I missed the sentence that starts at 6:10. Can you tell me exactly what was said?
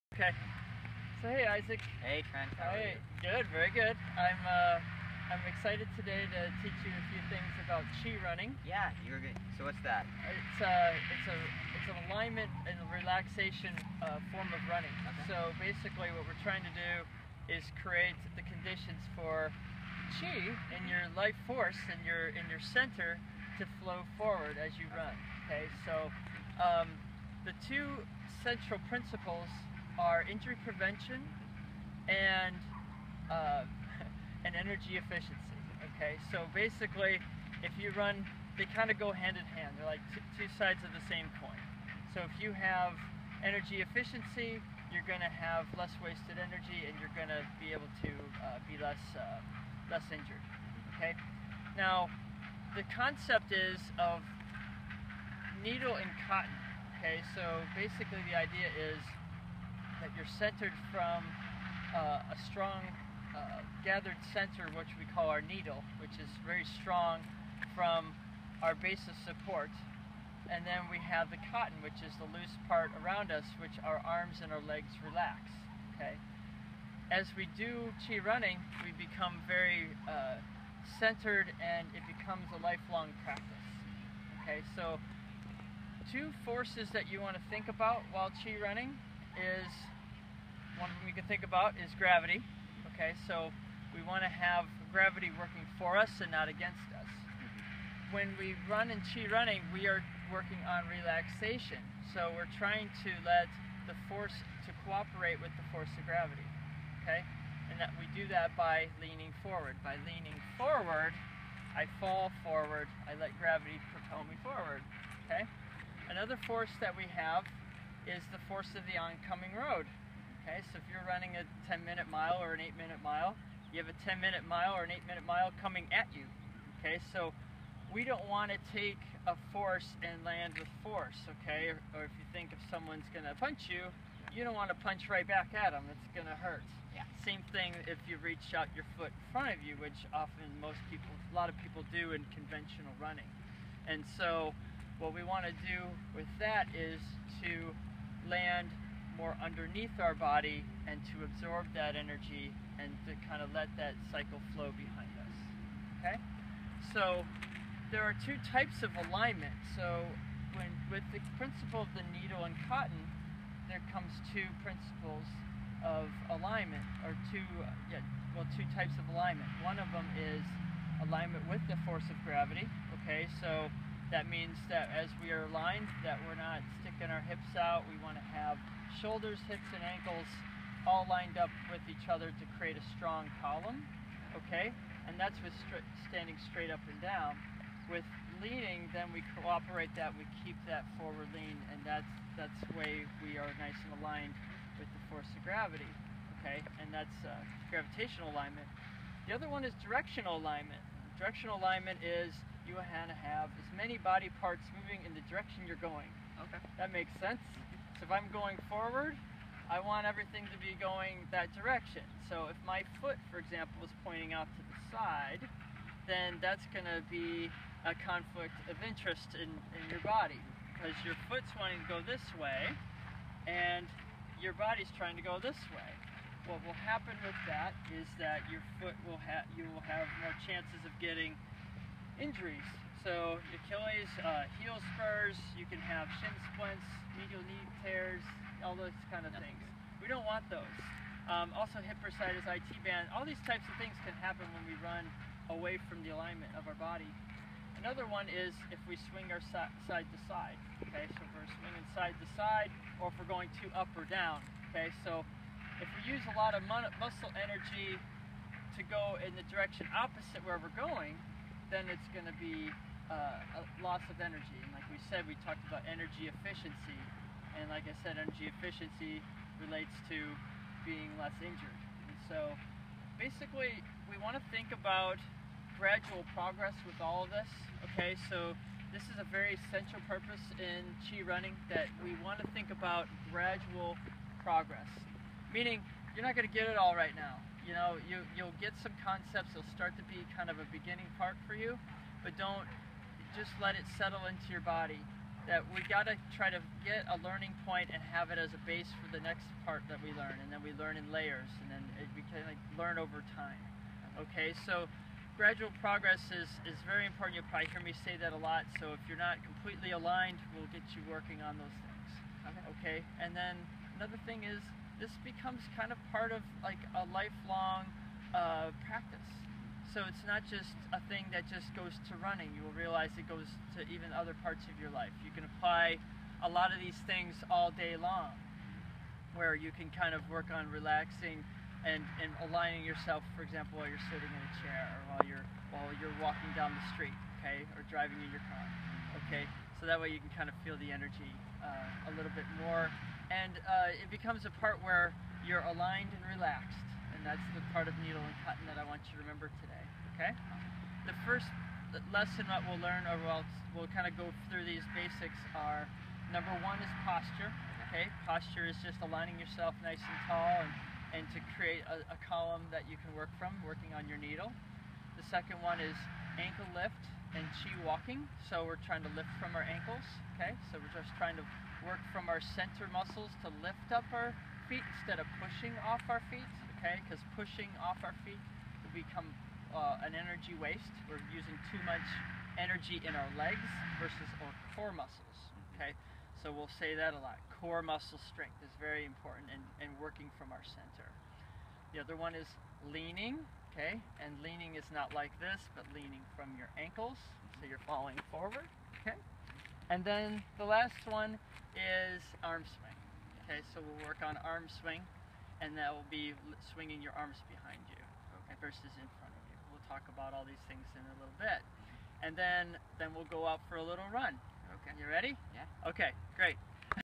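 So we're just trying to work from our center muscles to lift up our feet instead of pushing off our feet, okay?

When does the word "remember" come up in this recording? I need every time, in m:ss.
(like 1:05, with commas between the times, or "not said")
5:49.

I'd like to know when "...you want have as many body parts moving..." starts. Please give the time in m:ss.
3:22.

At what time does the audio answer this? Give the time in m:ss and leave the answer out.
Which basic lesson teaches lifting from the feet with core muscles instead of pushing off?
6:06.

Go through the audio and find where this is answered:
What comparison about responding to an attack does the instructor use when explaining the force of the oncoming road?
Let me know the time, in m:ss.
2:14.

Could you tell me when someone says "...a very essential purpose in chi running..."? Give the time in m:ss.
4:39.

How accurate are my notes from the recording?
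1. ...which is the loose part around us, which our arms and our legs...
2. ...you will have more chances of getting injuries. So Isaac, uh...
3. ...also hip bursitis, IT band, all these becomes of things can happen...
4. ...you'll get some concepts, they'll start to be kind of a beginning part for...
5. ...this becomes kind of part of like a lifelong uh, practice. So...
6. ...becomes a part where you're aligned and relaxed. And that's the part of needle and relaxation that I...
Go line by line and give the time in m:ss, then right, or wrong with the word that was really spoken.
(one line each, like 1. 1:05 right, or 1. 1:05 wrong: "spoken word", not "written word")
1. 1:11 right
2. 3:49 wrong: "Achilles", not "Isaac"
3. 4:01 wrong: "types", not "becomes"
4. 4:48 right
5. 5:15 right
6. 5:44 wrong: "cotton", not "relaxation".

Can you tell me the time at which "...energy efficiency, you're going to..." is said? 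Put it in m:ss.
0:43.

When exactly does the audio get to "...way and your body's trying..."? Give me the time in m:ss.
3:42.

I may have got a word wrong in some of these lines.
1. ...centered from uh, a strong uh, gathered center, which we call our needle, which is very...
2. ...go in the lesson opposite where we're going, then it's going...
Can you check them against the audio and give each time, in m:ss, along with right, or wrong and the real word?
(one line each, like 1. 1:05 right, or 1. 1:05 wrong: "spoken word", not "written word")
1. 1:00 right
2. 4:18 wrong: "direction", not "lesson".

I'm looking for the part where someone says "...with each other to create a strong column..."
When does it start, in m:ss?
3:01.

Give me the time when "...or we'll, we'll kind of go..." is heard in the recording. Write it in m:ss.
5:53.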